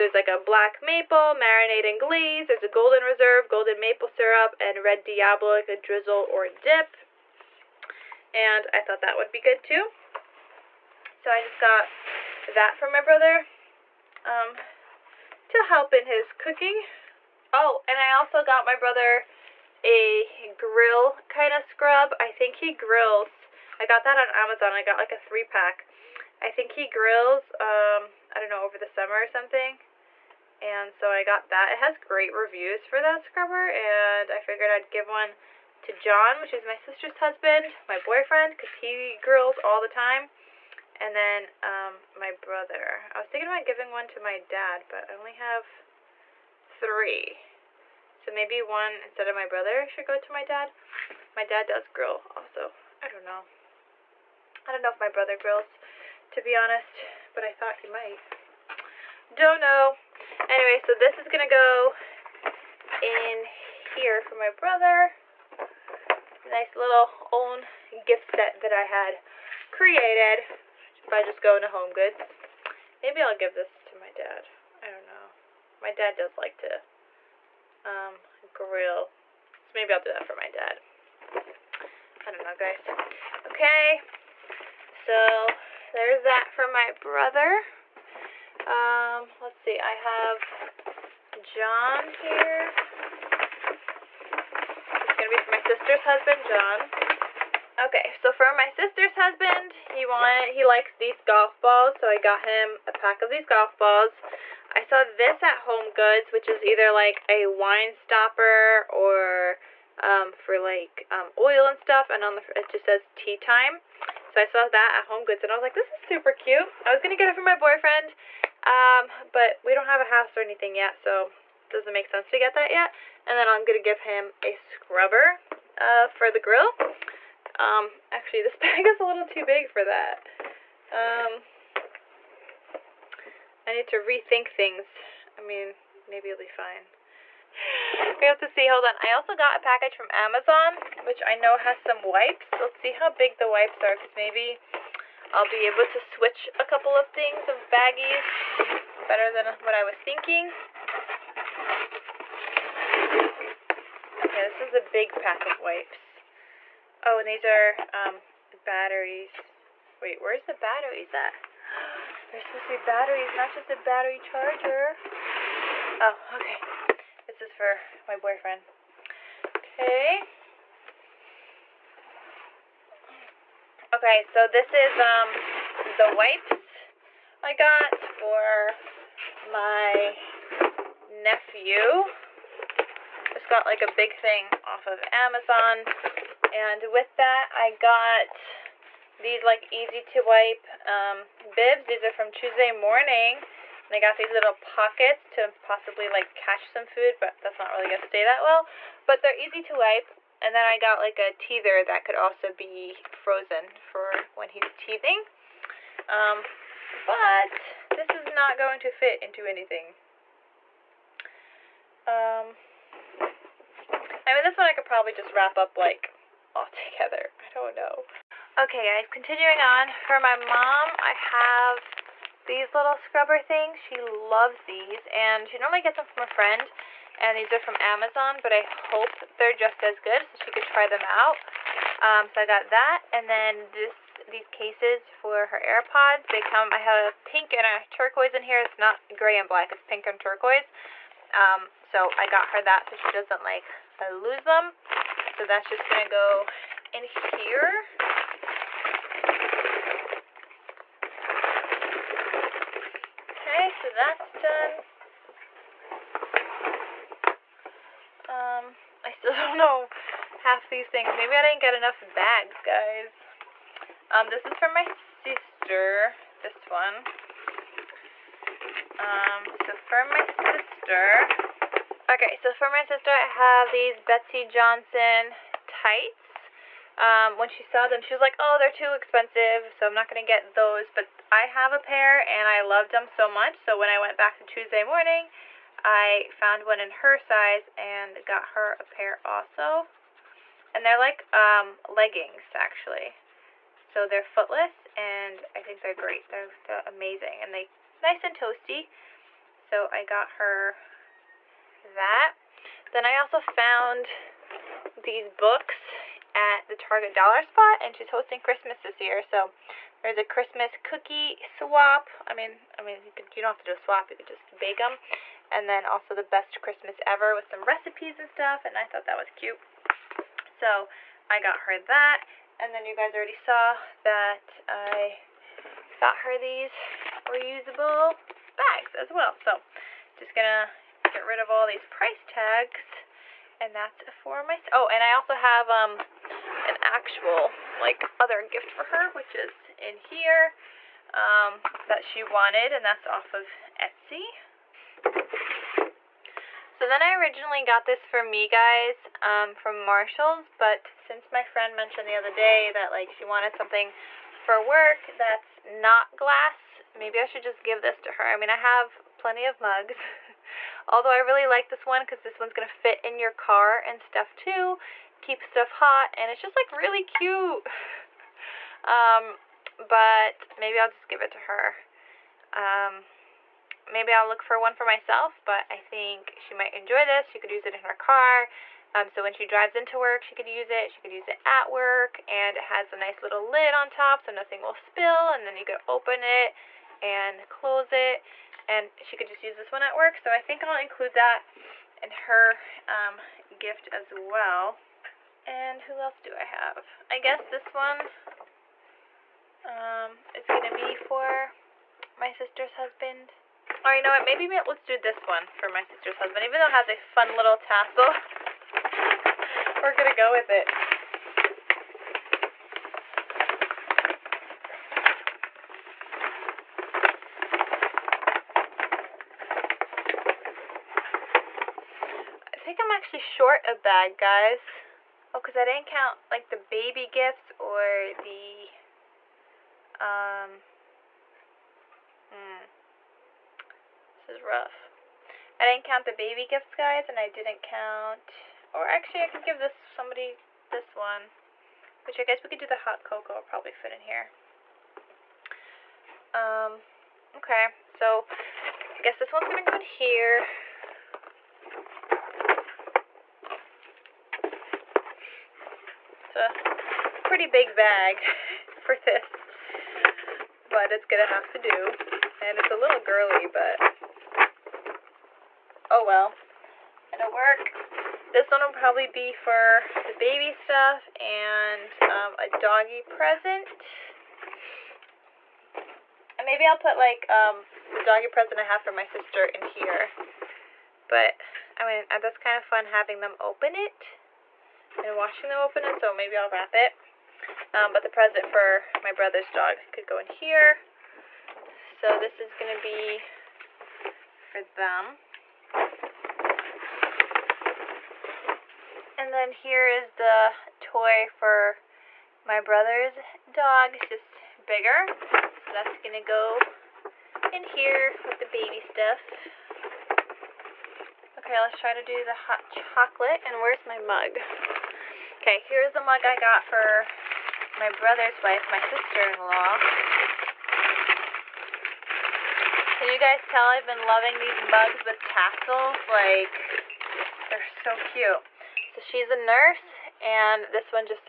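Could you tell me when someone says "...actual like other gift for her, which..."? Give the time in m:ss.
5:36.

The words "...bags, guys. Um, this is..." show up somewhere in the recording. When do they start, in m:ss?
4:22.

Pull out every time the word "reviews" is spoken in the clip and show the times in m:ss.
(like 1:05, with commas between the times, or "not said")
0:32.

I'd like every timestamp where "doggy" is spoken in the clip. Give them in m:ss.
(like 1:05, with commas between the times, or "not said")
7:52, 7:58.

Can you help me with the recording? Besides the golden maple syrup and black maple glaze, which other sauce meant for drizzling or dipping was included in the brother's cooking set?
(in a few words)
Red Diablo.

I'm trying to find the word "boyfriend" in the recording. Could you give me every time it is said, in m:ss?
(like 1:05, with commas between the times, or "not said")
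0:38, 1:57, 2:48.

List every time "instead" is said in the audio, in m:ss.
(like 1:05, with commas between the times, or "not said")
0:48.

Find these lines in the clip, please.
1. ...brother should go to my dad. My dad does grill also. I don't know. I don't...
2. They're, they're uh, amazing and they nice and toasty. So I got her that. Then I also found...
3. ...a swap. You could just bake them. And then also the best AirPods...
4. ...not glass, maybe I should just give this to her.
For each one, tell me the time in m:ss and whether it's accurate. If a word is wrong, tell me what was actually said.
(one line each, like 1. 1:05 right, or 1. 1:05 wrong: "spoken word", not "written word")
1. 0:49 right
2. 4:56 right
3. 5:13 wrong: "Christmas", not "AirPods"
4. 5:55 right.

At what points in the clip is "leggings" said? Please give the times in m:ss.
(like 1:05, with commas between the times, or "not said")
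4:51.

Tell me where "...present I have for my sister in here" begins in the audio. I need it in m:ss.
7:58.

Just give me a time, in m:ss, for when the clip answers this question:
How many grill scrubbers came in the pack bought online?
0:25.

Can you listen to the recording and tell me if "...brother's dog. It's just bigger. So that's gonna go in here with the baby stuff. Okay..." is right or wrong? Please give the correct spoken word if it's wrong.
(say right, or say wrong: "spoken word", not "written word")
right.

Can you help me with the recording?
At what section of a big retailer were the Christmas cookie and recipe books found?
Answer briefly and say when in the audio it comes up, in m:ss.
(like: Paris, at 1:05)
Target Dollar Spot, at 5:06.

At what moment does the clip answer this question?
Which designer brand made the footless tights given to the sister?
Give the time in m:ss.
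4:34.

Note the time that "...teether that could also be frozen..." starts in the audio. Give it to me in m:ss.
3:21.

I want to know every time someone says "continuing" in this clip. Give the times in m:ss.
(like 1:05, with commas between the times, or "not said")
3:39.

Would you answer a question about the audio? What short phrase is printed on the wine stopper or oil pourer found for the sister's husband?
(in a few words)
Tea time.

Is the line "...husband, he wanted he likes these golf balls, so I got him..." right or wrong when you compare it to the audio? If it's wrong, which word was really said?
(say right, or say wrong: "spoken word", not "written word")
right.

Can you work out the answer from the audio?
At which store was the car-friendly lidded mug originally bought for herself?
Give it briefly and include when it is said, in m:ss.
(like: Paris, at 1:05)
Marshalls, at 5:49.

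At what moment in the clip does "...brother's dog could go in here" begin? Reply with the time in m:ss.
8:09.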